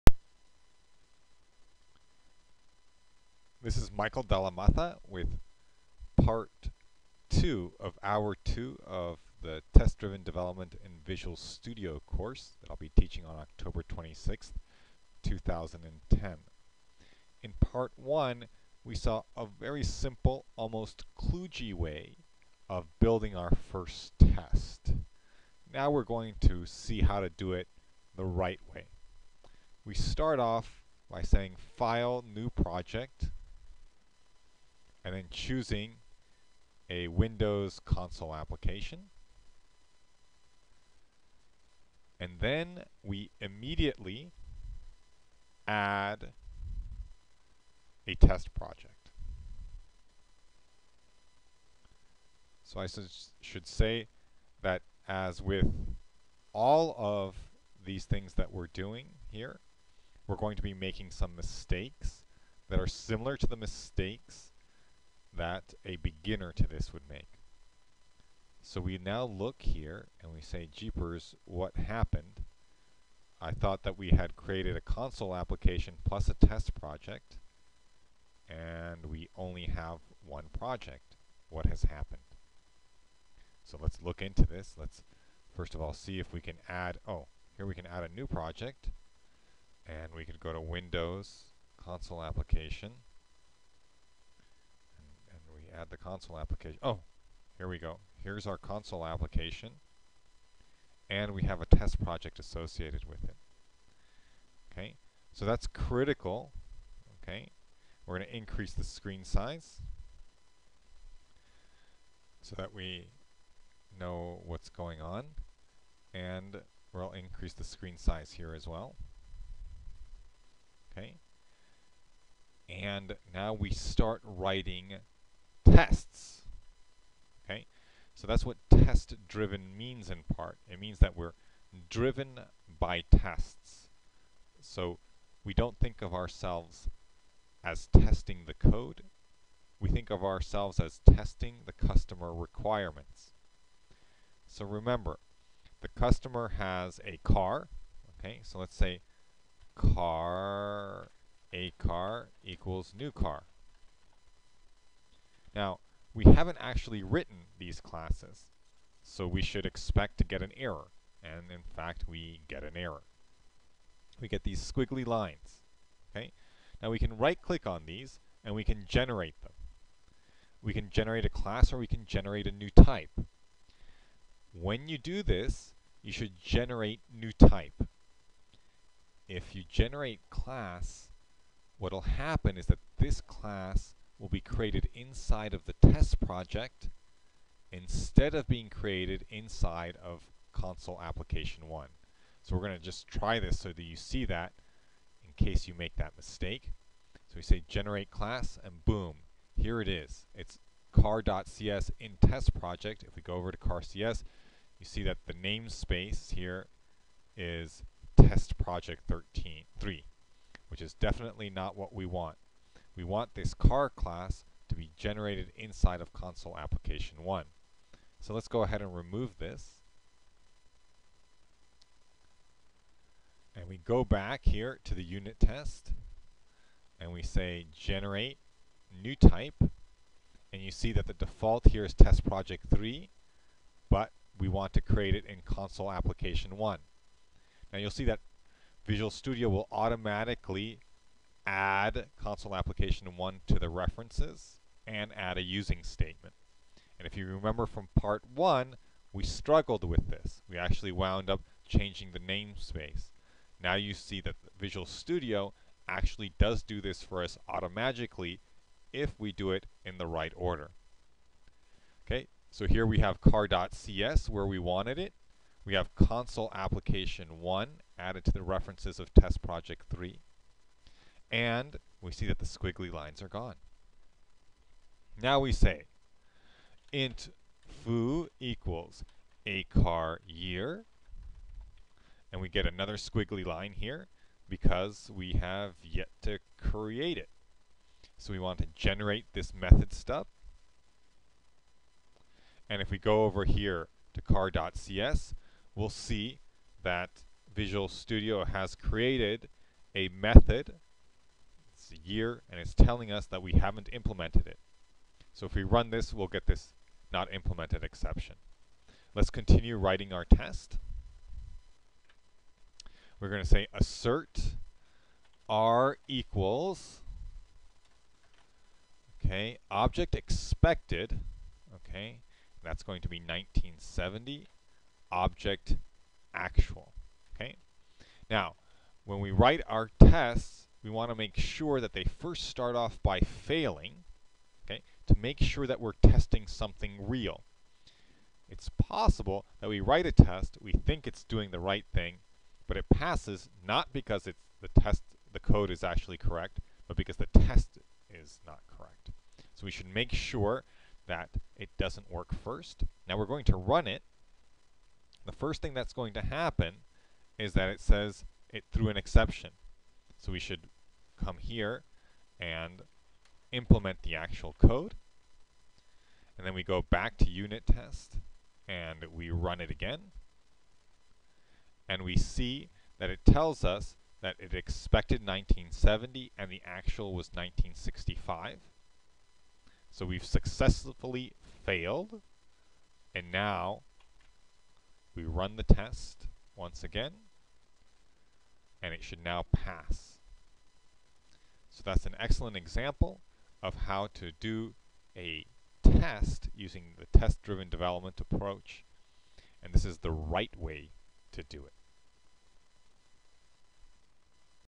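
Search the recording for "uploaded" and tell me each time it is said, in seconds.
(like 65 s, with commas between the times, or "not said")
not said.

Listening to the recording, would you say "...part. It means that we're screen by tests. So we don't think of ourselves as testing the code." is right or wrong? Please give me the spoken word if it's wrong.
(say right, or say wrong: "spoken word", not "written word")
wrong: "driven", not "screen".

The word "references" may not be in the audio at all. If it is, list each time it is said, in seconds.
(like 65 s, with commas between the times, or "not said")
243 s, 268 s.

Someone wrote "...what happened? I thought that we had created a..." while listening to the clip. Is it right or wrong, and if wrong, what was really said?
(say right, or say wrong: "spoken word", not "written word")
right.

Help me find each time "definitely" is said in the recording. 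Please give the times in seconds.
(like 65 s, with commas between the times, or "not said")
210 s.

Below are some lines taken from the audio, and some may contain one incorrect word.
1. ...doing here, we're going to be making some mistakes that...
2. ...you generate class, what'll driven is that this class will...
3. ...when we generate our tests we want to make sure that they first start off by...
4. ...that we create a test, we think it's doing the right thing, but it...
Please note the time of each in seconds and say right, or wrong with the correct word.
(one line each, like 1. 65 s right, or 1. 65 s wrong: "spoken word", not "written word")
1. 58 s right
2. 179 s wrong: "happen", not "driven"
3. 329 s wrong: "write", not "generate"
4. 339 s wrong: "write", not "create".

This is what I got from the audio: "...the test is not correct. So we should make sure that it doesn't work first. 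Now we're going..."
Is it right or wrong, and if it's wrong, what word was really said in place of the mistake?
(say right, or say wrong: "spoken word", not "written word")
right.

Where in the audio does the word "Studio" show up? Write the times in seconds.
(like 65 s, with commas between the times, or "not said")
11 s, 239 s, 254 s, 297 s.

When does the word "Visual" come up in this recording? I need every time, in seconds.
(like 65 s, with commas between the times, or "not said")
11 s, 238 s, 254 s, 297 s.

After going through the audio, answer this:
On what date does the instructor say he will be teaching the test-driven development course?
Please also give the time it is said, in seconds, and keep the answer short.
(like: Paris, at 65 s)
October 26th, 2010, at 13 s.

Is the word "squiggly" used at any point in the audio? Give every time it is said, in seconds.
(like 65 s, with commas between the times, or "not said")
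164 s, 272 s, 282 s.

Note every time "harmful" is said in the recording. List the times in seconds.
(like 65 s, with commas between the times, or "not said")
not said.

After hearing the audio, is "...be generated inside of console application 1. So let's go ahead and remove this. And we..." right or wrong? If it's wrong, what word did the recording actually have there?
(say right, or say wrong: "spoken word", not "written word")
right.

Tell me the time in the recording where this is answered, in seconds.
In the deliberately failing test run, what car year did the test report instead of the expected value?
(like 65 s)
377 s.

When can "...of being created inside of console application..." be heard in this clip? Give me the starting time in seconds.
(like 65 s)
188 s.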